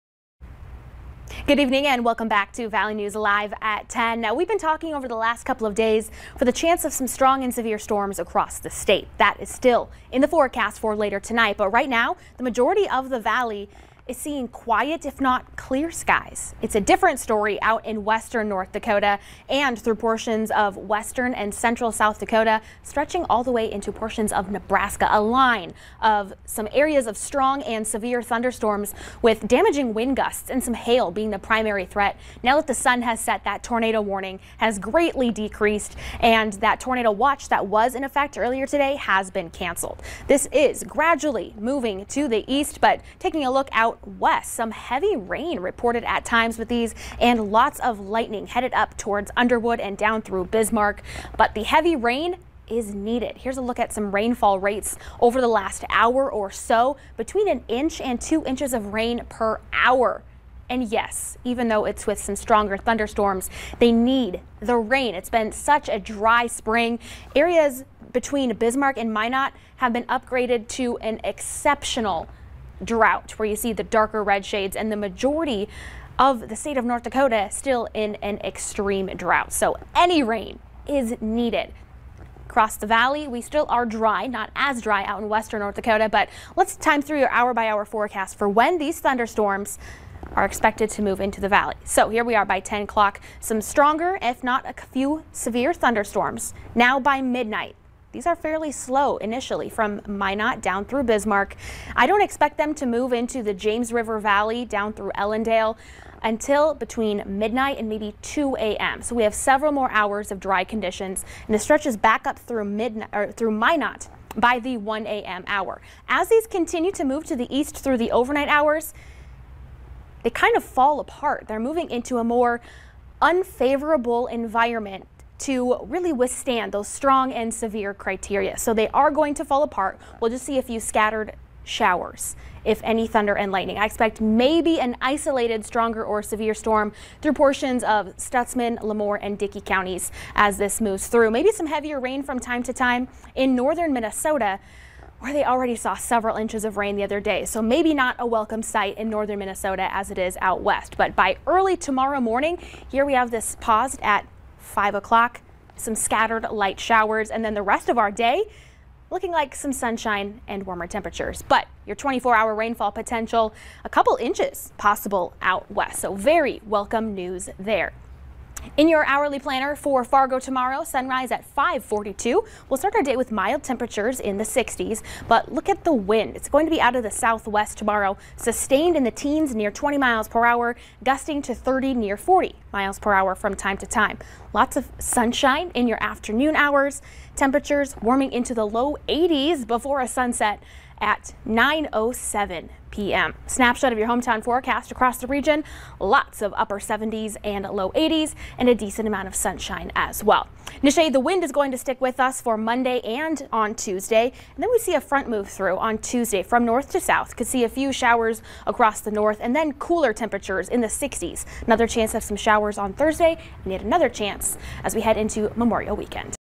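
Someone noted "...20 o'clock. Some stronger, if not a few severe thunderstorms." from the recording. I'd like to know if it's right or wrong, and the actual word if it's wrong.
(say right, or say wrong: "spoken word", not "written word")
wrong: "10", not "20".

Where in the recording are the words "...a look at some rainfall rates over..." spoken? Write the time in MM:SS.
00:53.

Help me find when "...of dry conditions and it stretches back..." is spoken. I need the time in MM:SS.
01:50.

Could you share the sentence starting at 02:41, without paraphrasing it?
But your 24-hour rainfall potential, a couple inches possible out west, so very welcome news there.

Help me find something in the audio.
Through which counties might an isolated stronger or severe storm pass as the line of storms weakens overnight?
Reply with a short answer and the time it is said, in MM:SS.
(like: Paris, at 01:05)
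Stutsman, LaMoure, and Dickey, at 02:18.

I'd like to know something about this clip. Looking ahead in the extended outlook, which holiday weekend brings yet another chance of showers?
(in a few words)
Memorial Weekend.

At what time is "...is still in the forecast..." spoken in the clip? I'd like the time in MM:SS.
00:09.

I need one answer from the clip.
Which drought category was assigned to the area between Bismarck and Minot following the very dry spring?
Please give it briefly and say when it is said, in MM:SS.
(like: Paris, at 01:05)
Exceptional drought, at 01:11.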